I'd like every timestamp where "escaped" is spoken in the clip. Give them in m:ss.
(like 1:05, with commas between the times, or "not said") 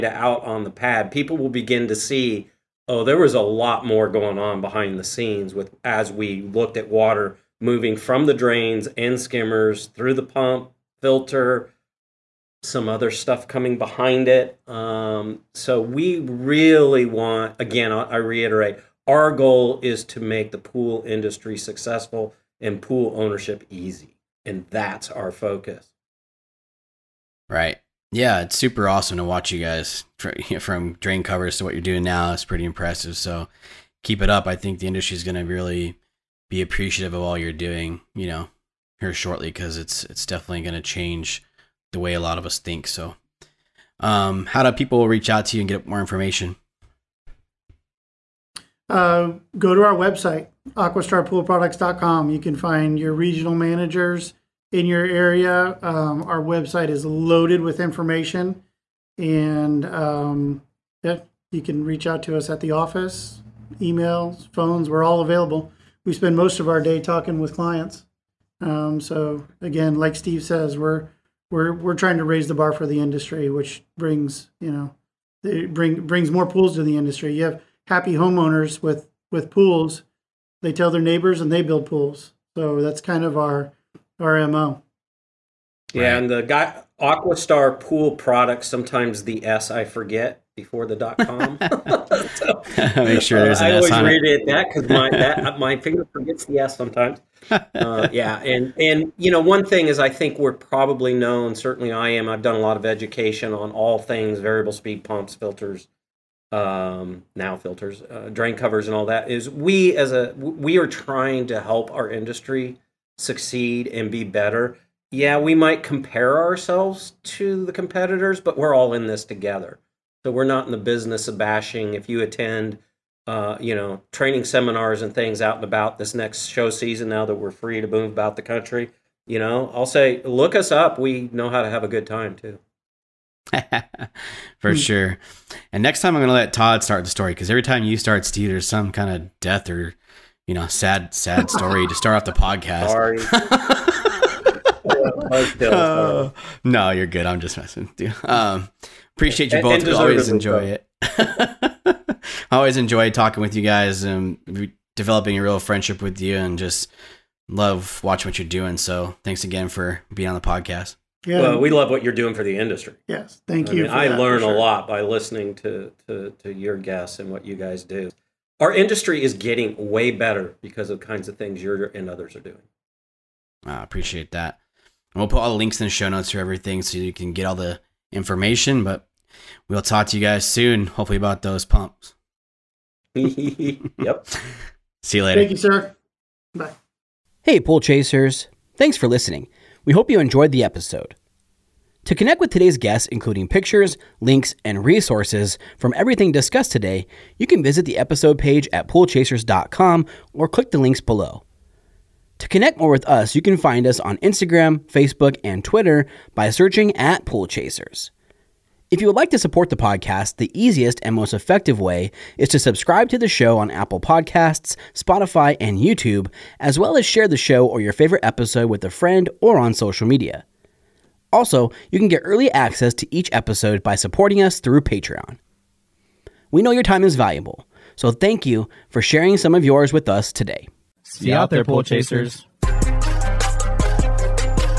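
not said.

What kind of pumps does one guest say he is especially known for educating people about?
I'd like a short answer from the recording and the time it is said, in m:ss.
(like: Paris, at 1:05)
variable speed pumps, at 1:44.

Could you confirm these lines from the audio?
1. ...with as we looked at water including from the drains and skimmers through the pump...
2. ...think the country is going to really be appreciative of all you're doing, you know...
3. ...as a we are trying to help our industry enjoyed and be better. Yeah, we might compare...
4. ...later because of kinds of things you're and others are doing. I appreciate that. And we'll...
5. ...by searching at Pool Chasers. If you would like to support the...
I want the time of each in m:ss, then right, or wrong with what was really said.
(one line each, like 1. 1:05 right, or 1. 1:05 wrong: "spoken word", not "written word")
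1. 0:05 wrong: "moving", not "including"
2. 0:34 wrong: "industry", not "country"
3. 1:49 wrong: "succeed", not "enjoyed"
4. 2:50 wrong: "better", not "later"
5. 3:26 right.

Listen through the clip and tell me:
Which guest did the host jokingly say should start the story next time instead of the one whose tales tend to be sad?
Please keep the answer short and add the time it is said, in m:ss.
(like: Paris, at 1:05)
Todd, at 2:16.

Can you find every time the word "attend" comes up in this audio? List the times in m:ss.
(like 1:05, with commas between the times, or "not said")
2:02.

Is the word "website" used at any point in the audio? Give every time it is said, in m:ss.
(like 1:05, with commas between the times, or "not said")
0:49, 0:56.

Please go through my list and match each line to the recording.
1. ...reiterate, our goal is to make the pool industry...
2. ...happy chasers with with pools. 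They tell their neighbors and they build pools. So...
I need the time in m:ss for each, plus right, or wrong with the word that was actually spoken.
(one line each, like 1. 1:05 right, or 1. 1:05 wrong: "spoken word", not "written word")
1. 0:18 right
2. 1:17 wrong: "homeowners", not "chasers".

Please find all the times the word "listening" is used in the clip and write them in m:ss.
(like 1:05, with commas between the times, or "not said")
2:45, 3:09.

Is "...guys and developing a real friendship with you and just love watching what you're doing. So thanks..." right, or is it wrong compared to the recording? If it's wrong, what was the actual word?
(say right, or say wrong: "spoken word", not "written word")
right.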